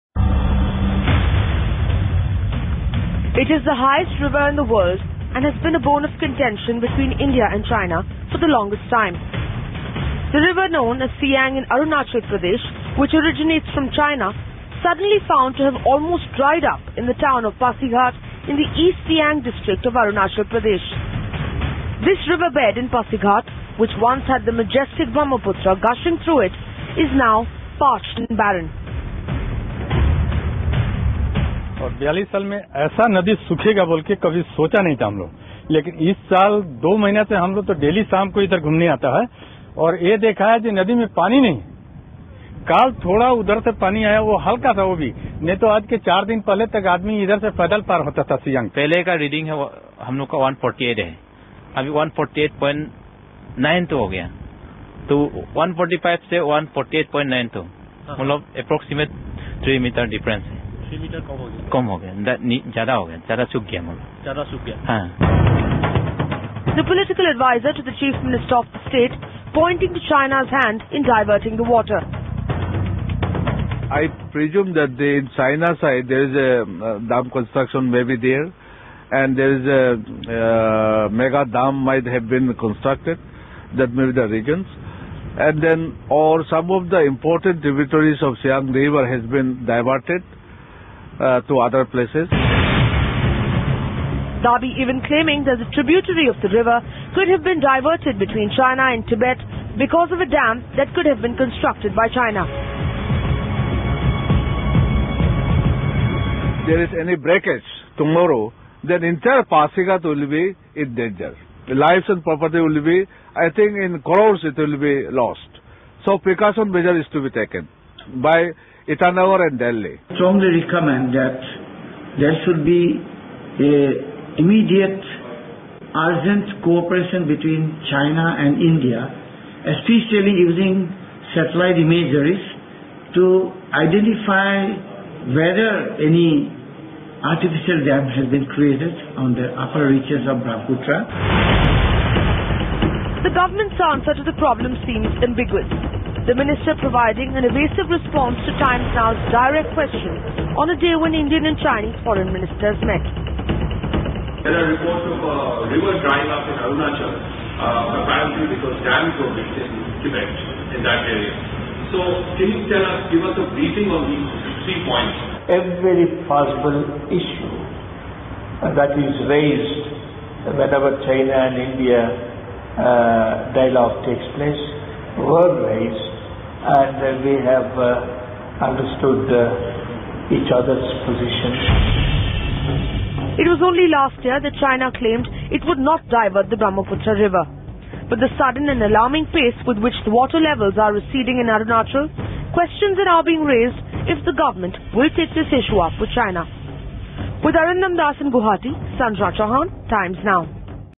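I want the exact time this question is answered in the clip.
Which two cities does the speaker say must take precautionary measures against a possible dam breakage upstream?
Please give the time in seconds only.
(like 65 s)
118 s.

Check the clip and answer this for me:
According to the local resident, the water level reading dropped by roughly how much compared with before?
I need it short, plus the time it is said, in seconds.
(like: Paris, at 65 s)
3 meters, at 59 s.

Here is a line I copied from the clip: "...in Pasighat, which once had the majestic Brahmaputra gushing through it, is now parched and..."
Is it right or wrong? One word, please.
right.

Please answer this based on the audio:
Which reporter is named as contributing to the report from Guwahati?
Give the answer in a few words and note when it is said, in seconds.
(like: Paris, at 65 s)
Arindam Das, at 197 s.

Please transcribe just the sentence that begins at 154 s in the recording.
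There are reports of a uh, river drying up in Arunachal, uh, apparently because dams were built in Tibet, in that area.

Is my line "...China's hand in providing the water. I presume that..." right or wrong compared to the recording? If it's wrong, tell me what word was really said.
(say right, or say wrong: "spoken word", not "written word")
wrong: "diverting", not "providing".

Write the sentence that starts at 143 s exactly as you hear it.
The government's answer to the problem seems ambiguous.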